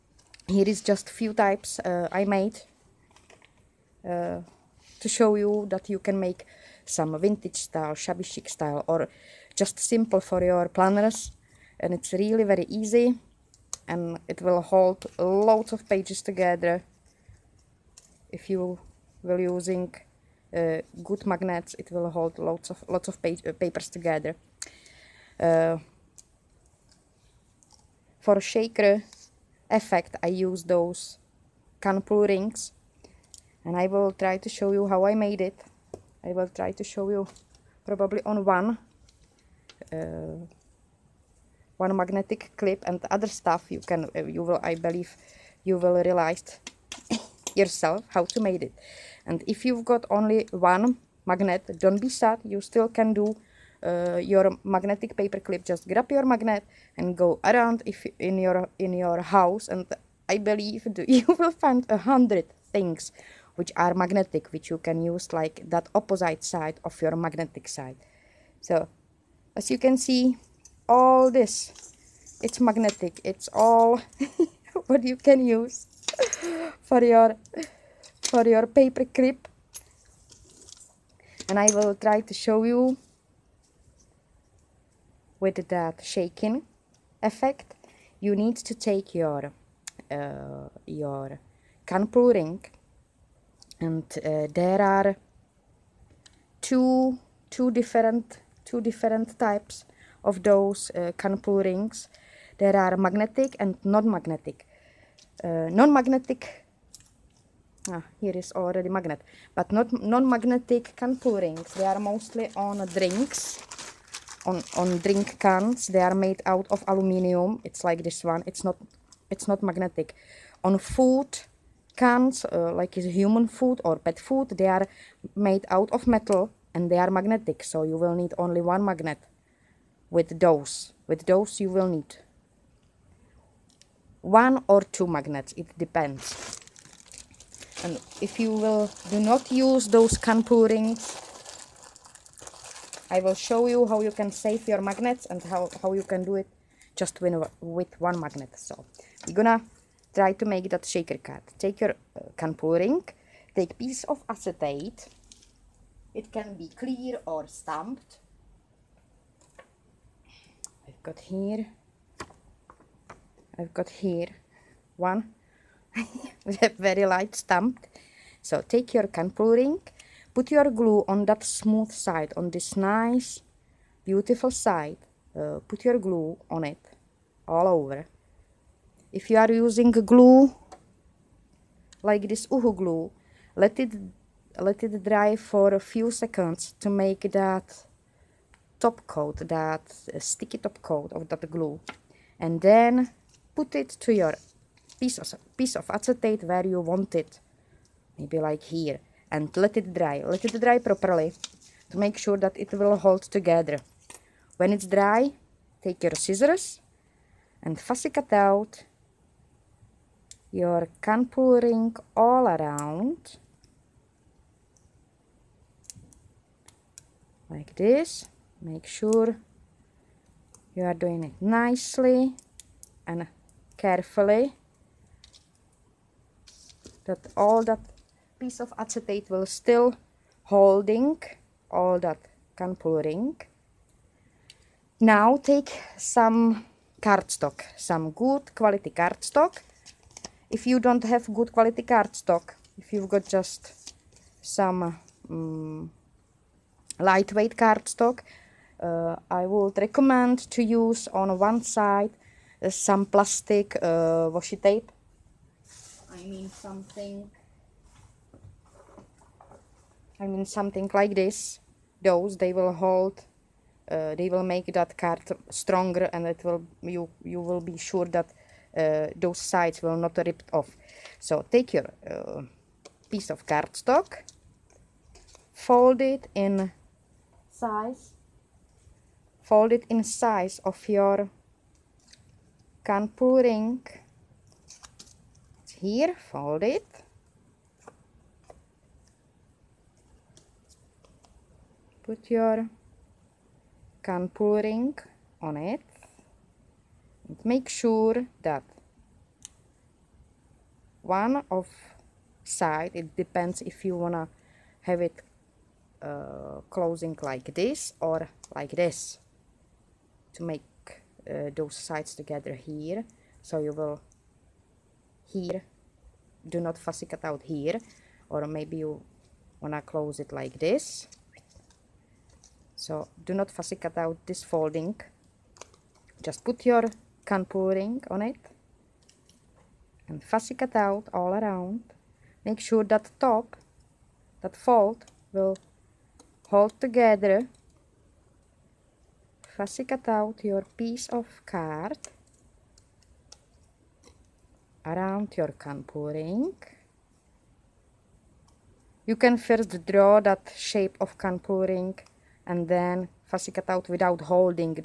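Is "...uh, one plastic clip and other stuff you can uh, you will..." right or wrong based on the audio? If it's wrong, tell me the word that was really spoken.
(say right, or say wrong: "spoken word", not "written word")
wrong: "magnetic", not "plastic".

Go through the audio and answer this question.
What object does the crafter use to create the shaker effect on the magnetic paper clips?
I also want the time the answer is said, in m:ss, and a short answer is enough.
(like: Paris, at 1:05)
can pull rings, at 0:31.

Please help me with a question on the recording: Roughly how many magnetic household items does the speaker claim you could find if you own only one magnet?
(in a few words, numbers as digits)
100.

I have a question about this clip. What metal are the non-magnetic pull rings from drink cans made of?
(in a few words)
aluminium.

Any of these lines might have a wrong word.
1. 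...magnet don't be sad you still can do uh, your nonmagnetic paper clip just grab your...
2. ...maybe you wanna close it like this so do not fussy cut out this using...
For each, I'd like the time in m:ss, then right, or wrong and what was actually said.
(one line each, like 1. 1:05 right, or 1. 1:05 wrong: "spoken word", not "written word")
1. 0:51 wrong: "magnetic", not "nonmagnetic"
2. 5:18 wrong: "folding", not "using".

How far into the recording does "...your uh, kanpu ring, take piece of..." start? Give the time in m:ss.
2:31.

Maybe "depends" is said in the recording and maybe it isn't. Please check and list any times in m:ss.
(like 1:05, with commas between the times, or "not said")
2:15, 5:03.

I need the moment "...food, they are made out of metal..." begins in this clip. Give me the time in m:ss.
2:04.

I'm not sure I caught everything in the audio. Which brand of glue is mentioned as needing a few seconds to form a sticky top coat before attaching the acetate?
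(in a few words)
UHU.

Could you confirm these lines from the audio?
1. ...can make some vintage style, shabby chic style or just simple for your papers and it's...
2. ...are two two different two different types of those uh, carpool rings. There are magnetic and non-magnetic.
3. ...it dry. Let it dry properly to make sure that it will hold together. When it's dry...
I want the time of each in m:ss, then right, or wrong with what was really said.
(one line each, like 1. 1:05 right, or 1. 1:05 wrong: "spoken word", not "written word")
1. 0:05 wrong: "planners", not "papers"
2. 1:34 right
3. 3:19 right.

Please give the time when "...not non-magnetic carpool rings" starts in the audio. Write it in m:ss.
1:49.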